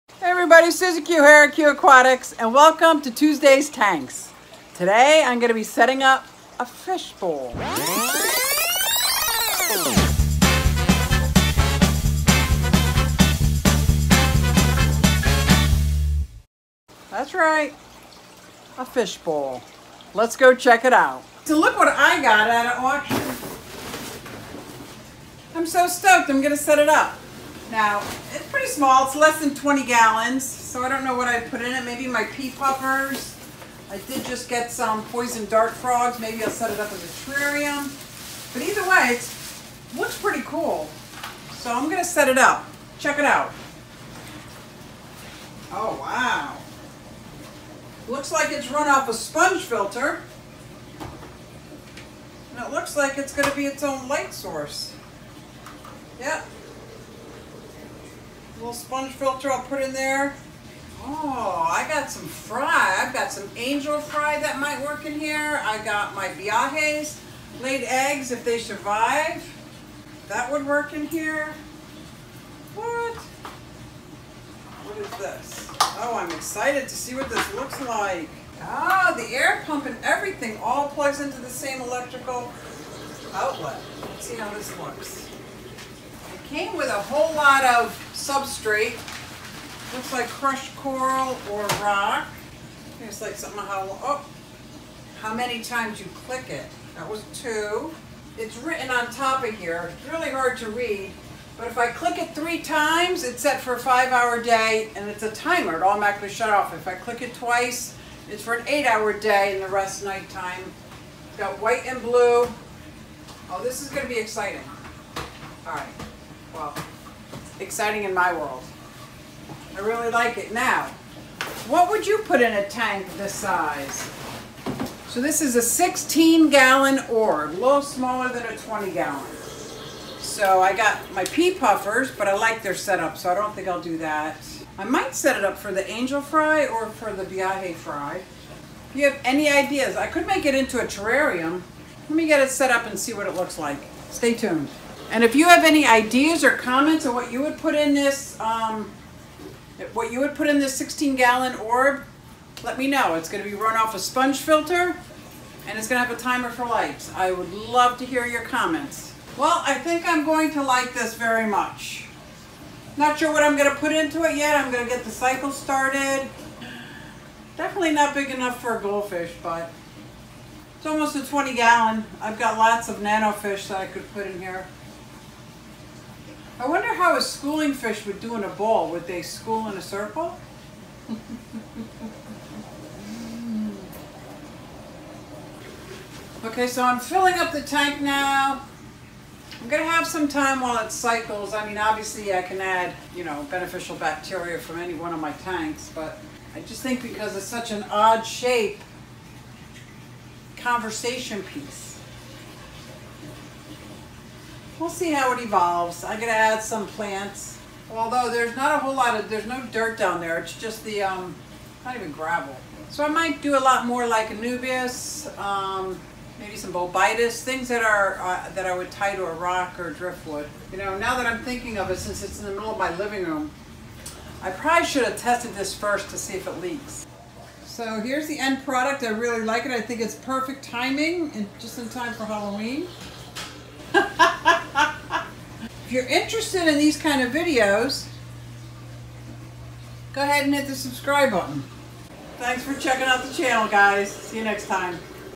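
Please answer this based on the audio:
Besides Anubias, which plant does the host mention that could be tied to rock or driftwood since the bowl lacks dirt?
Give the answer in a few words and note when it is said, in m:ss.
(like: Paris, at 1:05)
Bolbitis, at 3:36.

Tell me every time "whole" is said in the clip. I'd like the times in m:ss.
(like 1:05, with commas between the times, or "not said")
1:27, 3:28.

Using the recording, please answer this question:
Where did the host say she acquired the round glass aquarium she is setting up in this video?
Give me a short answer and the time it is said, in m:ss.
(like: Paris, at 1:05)
At an auction, at 0:22.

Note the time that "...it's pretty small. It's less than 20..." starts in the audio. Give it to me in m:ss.
0:28.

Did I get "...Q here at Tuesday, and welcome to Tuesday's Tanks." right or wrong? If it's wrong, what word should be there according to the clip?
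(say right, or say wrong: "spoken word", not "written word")
wrong: "QueAquatics", not "Tuesday".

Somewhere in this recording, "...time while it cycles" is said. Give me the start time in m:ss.
3:10.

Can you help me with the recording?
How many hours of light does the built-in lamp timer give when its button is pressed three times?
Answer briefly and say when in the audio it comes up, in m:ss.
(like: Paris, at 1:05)
5 hours, at 1:43.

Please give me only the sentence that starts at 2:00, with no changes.
Now, what would you put in a tank this size?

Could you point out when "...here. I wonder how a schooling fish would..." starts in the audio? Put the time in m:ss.
2:54.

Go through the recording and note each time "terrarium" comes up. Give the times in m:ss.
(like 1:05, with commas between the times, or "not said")
0:37, 2:20.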